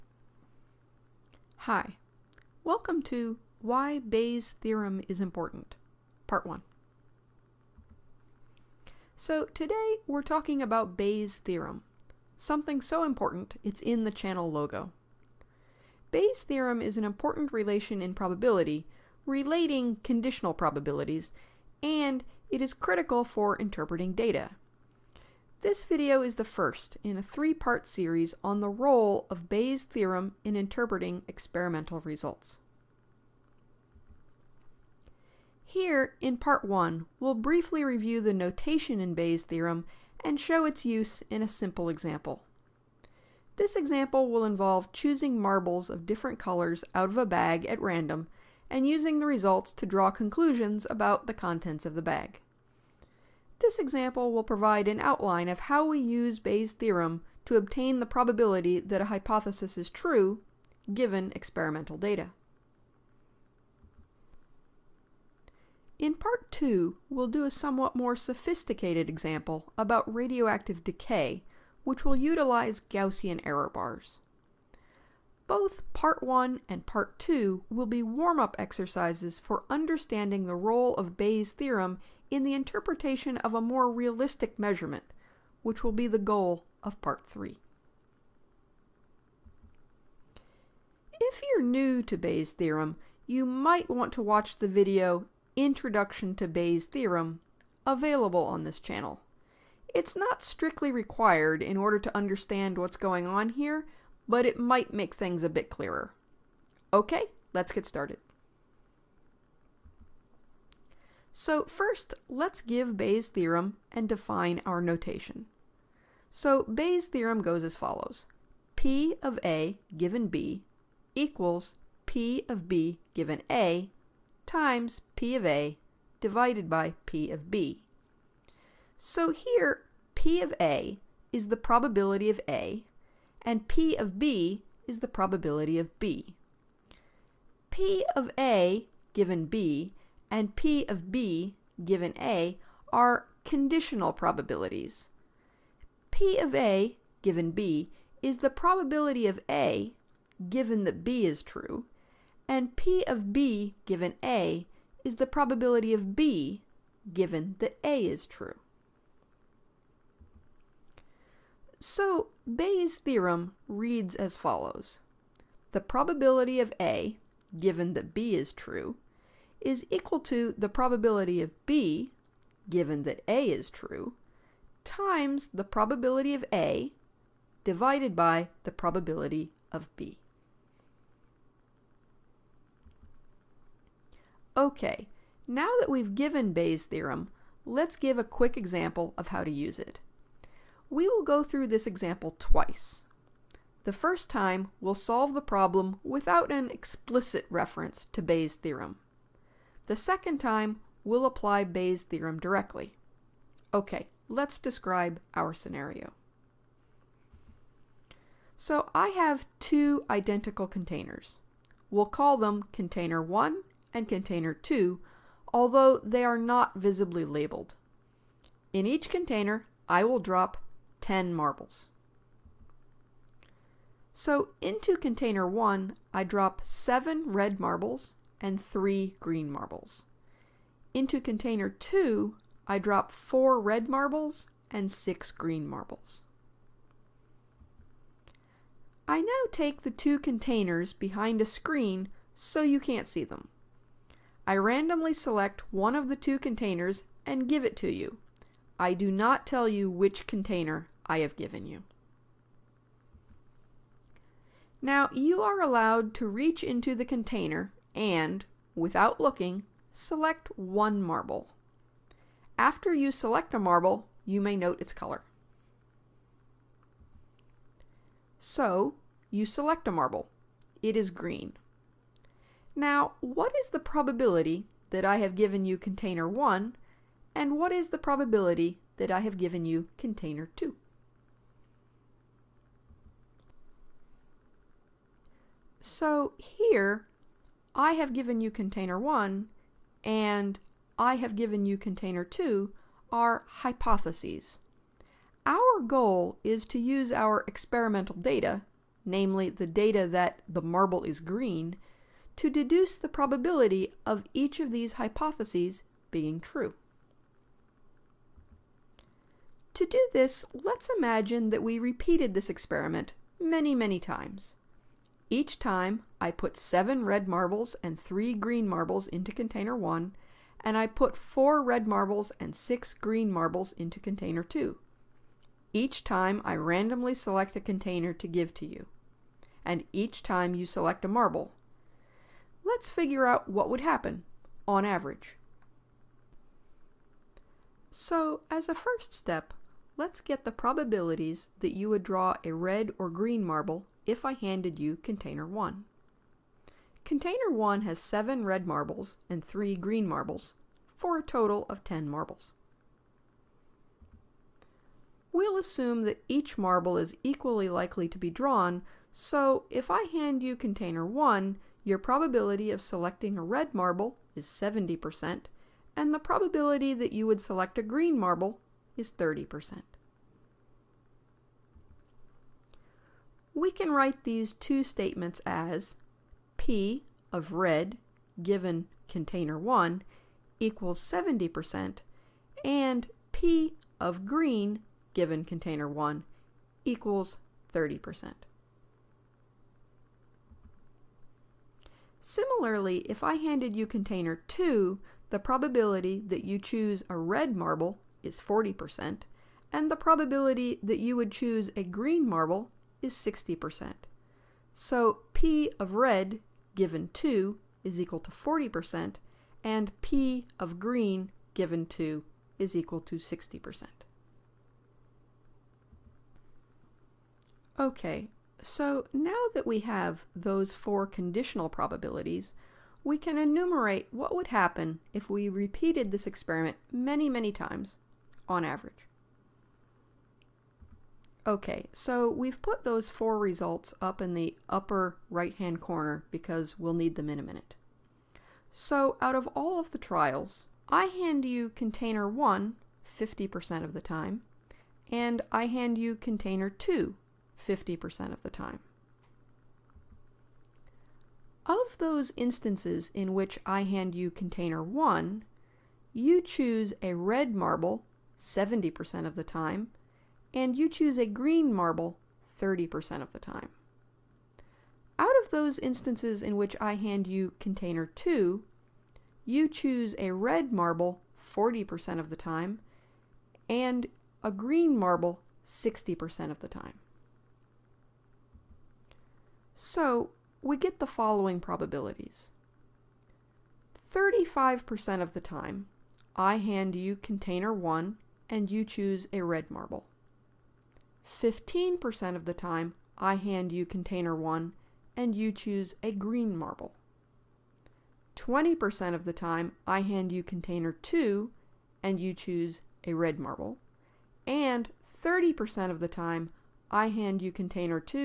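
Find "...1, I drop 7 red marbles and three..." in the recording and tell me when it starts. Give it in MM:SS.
03:45.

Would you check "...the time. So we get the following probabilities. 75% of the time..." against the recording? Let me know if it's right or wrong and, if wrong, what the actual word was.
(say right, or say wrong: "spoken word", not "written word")
wrong: "35", not "75".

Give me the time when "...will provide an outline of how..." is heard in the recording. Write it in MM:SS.
00:54.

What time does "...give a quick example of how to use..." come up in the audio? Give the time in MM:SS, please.
03:07.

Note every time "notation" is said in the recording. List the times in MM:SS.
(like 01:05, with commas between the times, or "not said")
00:38, 01:54.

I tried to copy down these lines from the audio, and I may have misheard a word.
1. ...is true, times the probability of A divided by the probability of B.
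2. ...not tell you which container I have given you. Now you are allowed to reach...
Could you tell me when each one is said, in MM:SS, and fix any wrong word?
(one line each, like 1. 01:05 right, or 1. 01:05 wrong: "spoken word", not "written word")
1. 02:53 right
2. 04:09 right.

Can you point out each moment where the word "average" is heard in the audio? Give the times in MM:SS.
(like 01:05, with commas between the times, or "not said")
05:34, 07:08.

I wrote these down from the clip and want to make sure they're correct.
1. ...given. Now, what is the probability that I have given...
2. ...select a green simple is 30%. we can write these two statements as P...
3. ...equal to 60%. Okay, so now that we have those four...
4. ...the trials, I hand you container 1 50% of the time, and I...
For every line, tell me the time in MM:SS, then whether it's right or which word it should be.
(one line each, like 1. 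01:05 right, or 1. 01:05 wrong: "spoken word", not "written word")
1. 04:31 wrong: "green", not "given"
2. 06:07 wrong: "marble", not "simple"
3. 06:52 right
4. 07:19 right.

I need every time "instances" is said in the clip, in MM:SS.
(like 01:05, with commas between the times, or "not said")
07:32, 07:45.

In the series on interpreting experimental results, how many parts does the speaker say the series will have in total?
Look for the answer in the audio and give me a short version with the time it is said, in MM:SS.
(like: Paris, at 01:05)
3, at 00:27.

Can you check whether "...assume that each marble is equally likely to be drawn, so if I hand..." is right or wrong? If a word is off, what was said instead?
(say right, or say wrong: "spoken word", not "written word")
right.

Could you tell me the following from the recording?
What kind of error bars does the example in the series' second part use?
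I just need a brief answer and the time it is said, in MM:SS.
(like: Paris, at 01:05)
Gaussian, at 01:12.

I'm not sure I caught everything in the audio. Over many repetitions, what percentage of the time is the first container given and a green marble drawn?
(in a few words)
15%.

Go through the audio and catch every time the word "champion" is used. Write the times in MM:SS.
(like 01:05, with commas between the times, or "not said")
not said.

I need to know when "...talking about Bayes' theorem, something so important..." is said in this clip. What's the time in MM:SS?
00:10.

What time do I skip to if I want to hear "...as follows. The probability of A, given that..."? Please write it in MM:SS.
02:44.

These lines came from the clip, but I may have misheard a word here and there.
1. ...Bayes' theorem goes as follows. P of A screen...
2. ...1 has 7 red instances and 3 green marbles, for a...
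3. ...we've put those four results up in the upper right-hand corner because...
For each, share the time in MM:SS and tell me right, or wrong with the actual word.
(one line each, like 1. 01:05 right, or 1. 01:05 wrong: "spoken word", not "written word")
1. 01:56 wrong: "given", not "screen"
2. 05:47 wrong: "marbles", not "instances"
3. 07:12 right.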